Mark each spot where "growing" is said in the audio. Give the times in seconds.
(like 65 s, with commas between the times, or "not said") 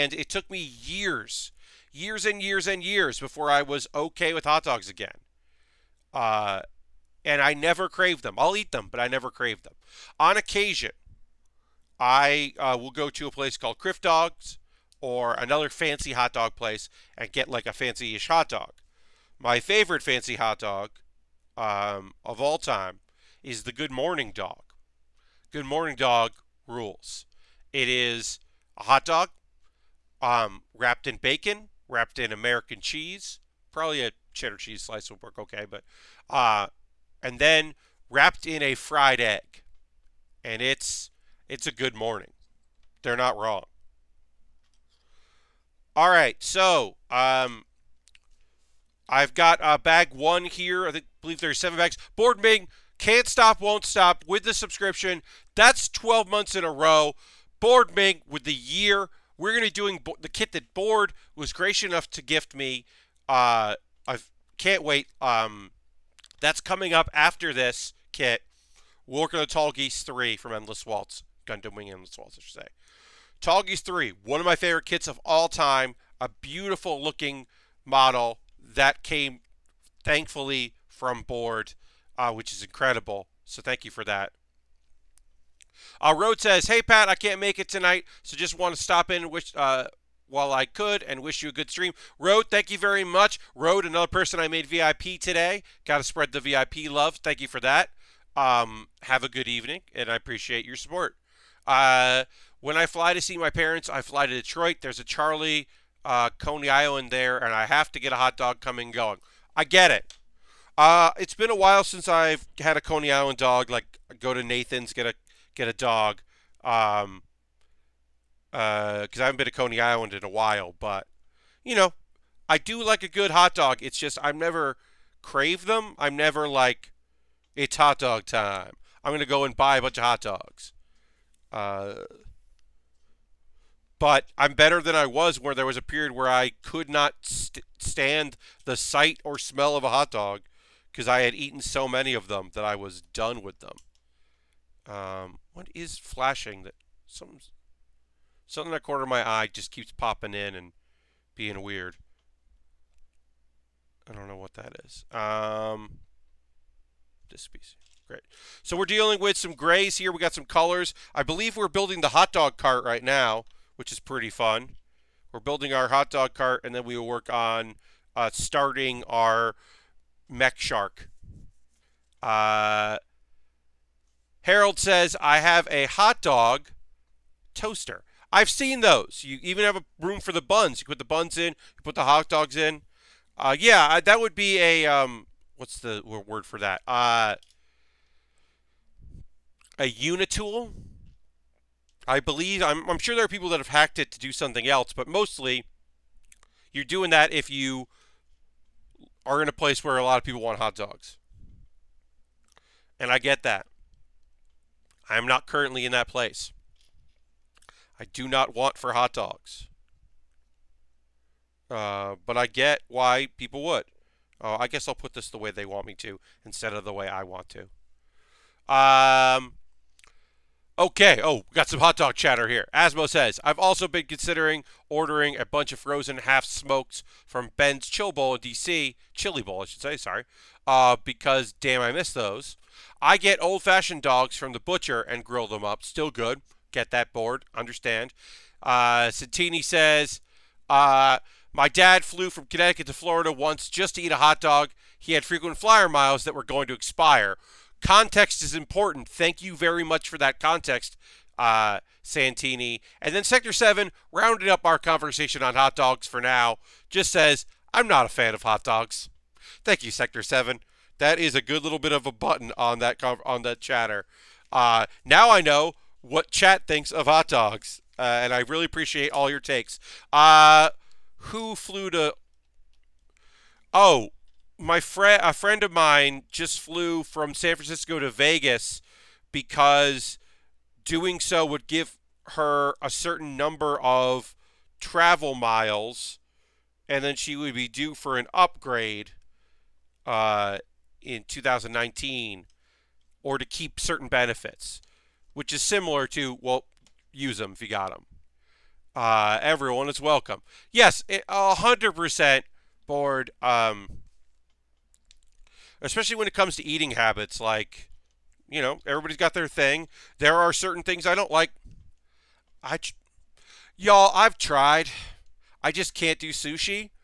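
not said.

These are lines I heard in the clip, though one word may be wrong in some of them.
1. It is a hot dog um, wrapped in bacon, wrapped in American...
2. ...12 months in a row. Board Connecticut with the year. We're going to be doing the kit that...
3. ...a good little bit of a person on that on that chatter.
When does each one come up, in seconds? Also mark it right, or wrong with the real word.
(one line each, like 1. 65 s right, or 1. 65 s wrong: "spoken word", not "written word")
1. 27 s right
2. 55 s wrong: "Ming", not "Connecticut"
3. 261 s wrong: "button", not "person".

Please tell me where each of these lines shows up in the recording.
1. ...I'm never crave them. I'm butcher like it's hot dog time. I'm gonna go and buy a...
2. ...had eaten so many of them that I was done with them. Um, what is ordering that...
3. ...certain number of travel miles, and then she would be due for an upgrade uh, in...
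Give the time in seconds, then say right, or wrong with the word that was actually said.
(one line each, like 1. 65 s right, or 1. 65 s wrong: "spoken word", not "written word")
1. 124 s wrong: "never", not "butcher"
2. 141 s wrong: "flashing", not "ordering"
3. 282 s right.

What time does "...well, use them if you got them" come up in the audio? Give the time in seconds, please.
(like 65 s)
296 s.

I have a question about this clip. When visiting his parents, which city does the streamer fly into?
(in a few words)
Detroit.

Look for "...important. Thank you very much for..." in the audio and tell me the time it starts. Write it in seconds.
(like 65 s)
248 s.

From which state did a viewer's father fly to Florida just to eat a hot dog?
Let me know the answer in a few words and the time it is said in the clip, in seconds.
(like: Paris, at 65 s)
Connecticut, at 242 s.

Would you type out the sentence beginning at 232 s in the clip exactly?
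I get old fashioned dogs from the butcher and grill them up.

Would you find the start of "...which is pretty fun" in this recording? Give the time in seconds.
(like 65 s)
163 s.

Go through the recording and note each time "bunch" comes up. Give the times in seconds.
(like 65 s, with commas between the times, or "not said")
129 s, 225 s.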